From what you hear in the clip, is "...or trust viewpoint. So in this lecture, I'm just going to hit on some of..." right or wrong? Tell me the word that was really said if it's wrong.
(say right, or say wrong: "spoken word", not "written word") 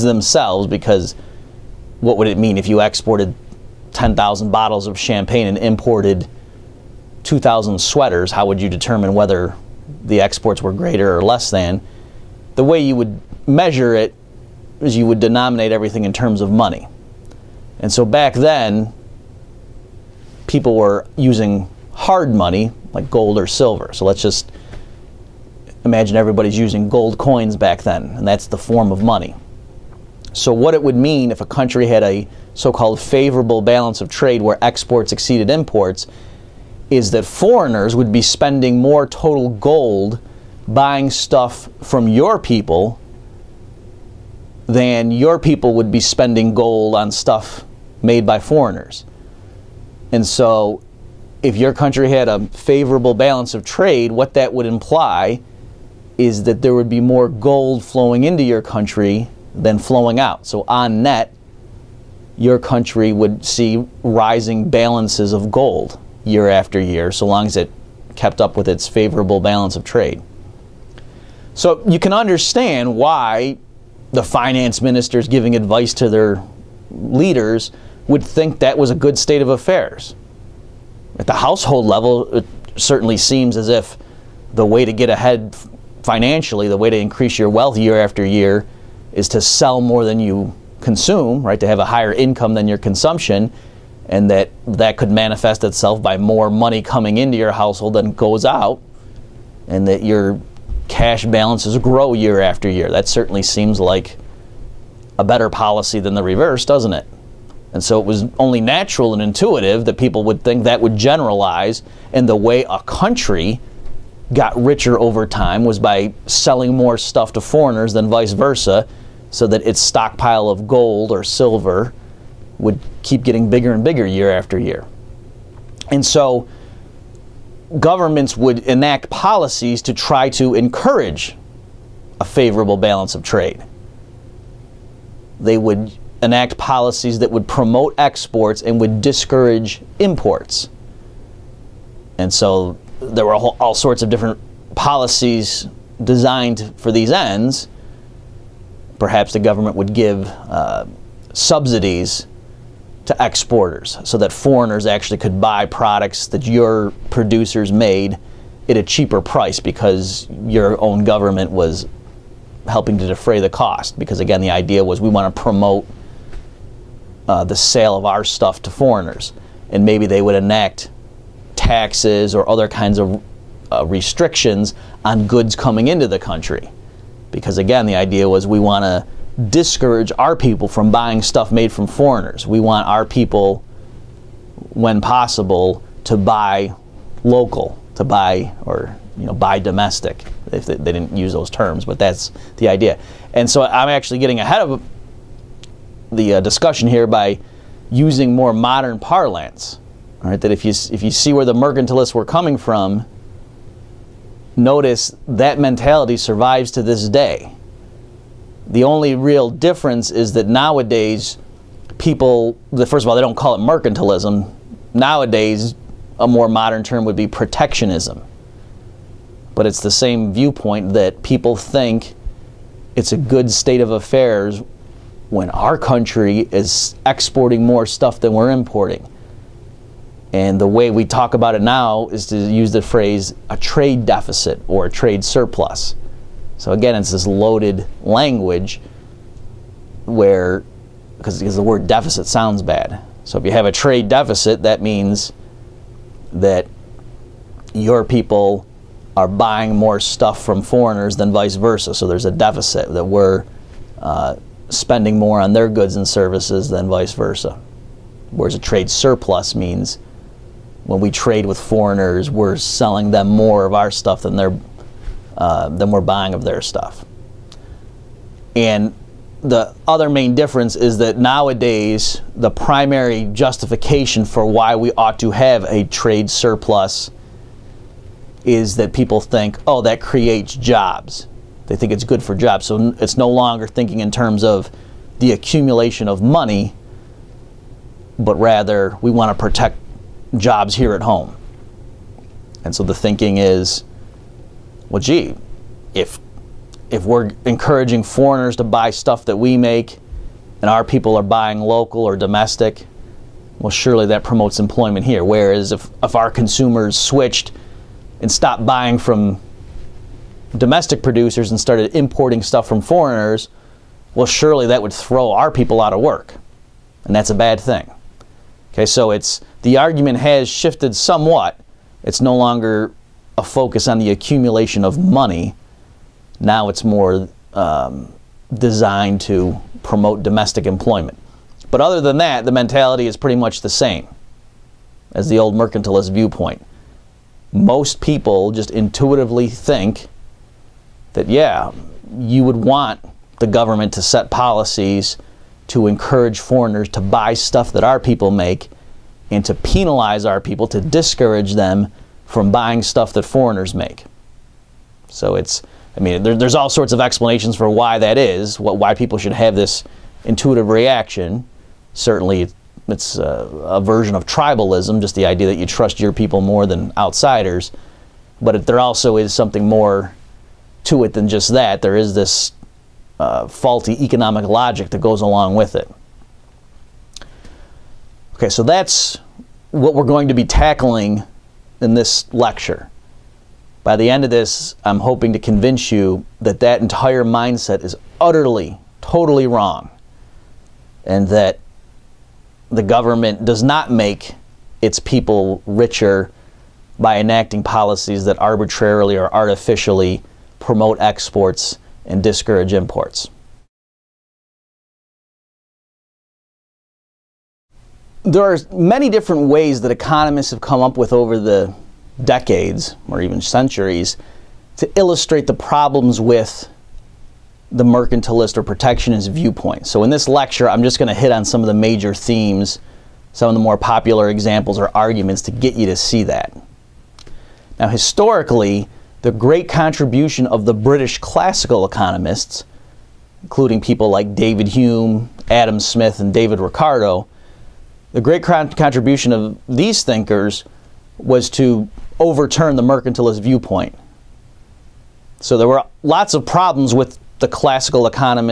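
wrong: "protectionist", not "trust".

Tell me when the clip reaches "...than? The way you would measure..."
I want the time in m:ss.
0:11.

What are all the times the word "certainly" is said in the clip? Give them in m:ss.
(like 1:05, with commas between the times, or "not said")
1:22, 1:43, 6:01.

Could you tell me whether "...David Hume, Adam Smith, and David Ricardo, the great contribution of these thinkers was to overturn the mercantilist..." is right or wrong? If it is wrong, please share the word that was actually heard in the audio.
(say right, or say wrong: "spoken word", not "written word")
right.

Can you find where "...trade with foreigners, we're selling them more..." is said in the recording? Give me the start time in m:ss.
4:21.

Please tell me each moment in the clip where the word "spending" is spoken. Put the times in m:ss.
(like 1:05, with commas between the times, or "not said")
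0:38, 0:45, 4:14.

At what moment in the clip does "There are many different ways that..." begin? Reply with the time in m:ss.
6:48.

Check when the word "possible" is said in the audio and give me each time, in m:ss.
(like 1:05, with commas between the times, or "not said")
3:04.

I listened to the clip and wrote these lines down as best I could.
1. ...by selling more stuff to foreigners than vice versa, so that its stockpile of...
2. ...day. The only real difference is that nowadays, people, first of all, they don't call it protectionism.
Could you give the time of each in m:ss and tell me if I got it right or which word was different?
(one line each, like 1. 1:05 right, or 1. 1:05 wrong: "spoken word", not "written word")
1. 1:55 right
2. 3:27 wrong: "mercantilism", not "protectionism".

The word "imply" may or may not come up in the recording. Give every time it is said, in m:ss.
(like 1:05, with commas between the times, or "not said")
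0:54.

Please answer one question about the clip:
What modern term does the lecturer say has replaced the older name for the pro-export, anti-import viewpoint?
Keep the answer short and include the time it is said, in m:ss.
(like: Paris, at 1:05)
protectionism, at 3:37.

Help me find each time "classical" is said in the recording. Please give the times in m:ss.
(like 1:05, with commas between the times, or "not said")
7:11, 7:27.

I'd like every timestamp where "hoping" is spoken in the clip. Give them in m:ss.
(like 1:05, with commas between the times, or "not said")
6:24.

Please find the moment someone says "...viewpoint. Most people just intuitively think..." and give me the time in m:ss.
5:36.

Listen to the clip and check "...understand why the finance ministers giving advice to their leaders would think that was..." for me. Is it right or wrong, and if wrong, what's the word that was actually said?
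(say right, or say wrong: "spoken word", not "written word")
right.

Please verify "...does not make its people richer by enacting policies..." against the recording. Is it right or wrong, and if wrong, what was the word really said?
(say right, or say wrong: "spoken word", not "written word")
right.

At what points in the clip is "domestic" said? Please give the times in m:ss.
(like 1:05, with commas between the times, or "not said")
3:09, 5:02, 5:10, 5:30.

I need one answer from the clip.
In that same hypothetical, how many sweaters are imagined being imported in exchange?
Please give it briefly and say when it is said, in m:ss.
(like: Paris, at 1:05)
2,000, at 0:07.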